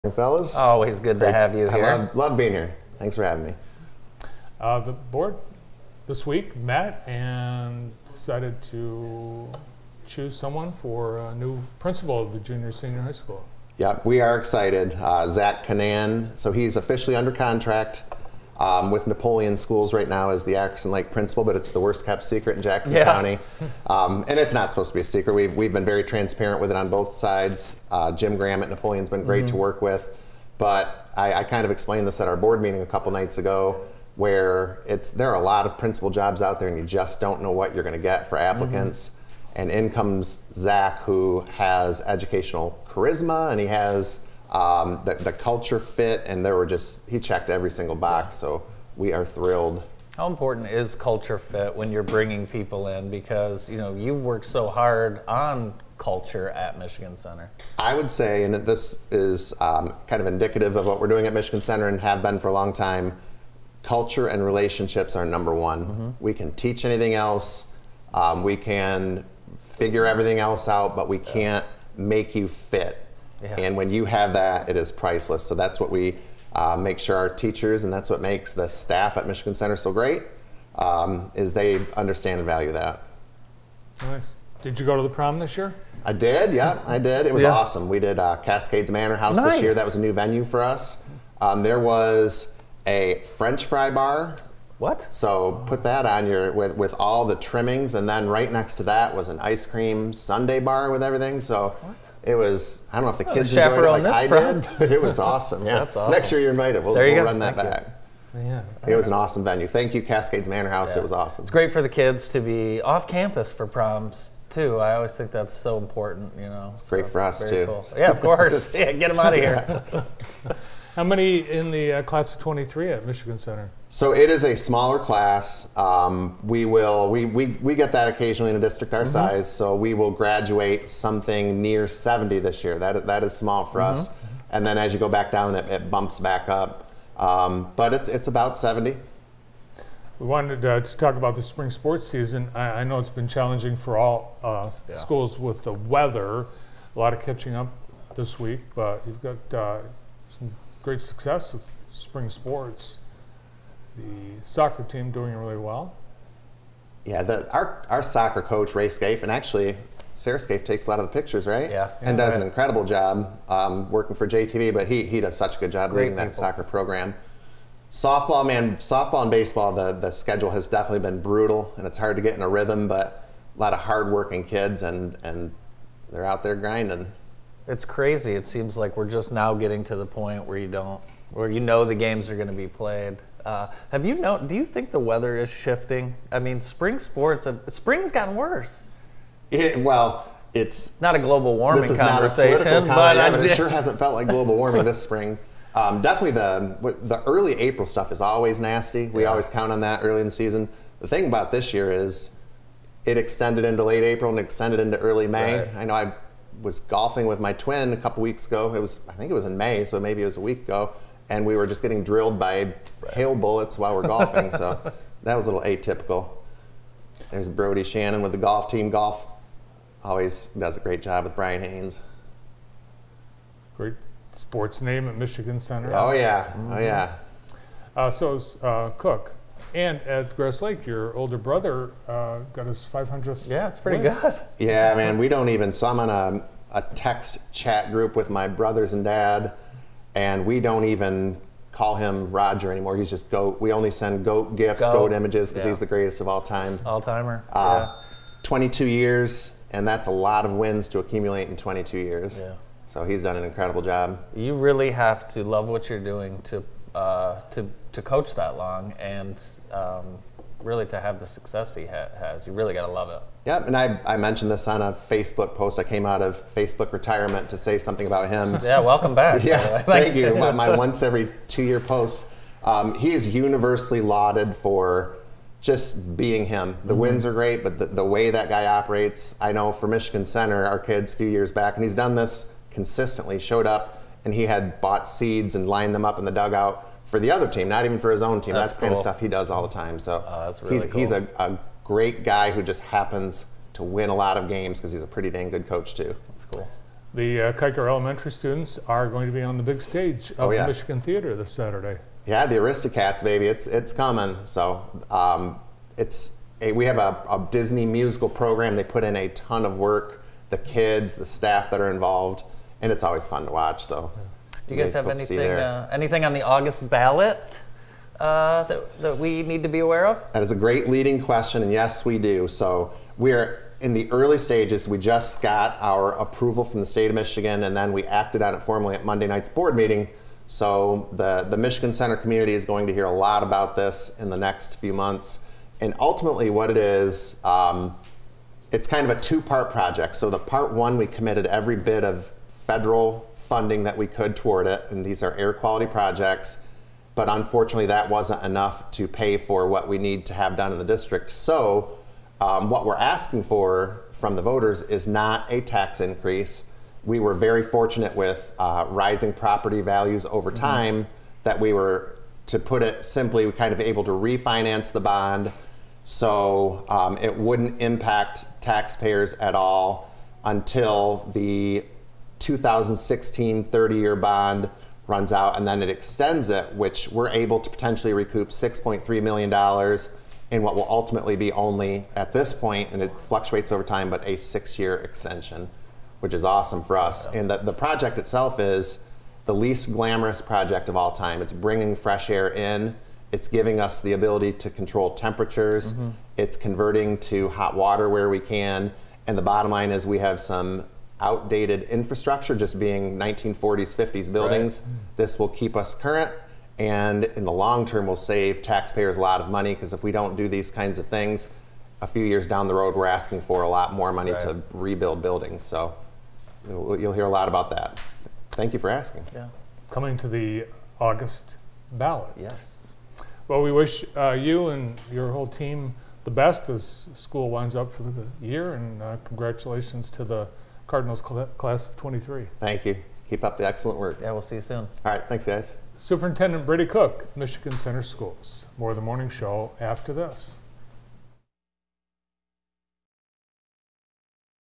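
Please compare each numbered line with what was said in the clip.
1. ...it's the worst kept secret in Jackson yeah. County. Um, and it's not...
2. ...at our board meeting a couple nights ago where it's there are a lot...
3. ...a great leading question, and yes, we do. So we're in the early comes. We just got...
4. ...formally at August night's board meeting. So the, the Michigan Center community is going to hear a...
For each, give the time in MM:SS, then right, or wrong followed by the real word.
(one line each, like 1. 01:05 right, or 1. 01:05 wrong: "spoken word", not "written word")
1. 00:21 right
2. 00:32 right
3. 05:20 wrong: "stages", not "comes"
4. 05:28 wrong: "Monday", not "August".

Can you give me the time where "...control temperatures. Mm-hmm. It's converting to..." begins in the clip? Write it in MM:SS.
06:34.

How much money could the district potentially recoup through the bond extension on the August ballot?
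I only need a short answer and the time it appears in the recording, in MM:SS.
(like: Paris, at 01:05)
$6.3 million, at 06:18.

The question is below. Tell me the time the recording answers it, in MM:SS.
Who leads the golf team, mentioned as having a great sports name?
03:41.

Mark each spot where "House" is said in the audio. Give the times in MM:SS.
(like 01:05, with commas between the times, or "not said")
01:29, 01:50.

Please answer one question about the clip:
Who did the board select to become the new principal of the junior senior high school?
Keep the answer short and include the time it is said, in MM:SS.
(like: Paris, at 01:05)
Zach Canan, at 00:15.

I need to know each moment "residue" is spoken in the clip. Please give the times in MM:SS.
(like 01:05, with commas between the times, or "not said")
not said.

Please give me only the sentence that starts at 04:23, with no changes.
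Yep, and I, I mentioned this on a Facebook post.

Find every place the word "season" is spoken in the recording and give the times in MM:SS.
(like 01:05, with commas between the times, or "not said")
02:22, 03:20.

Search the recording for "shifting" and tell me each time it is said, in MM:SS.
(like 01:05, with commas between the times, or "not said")
03:05.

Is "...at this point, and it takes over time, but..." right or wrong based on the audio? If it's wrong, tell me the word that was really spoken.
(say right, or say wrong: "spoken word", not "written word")
wrong: "fluctuates", not "takes".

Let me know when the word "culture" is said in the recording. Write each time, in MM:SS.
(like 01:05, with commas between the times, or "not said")
00:45, 00:50, 00:55, 01:03.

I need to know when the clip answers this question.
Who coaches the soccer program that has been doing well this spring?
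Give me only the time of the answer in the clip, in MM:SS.
02:38.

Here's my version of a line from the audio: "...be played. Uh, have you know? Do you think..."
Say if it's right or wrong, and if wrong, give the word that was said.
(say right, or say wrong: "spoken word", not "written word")
right.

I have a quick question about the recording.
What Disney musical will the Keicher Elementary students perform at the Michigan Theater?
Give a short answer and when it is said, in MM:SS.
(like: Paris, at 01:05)
The Aristocats, at 05:02.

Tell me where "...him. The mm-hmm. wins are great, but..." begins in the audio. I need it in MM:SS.
04:36.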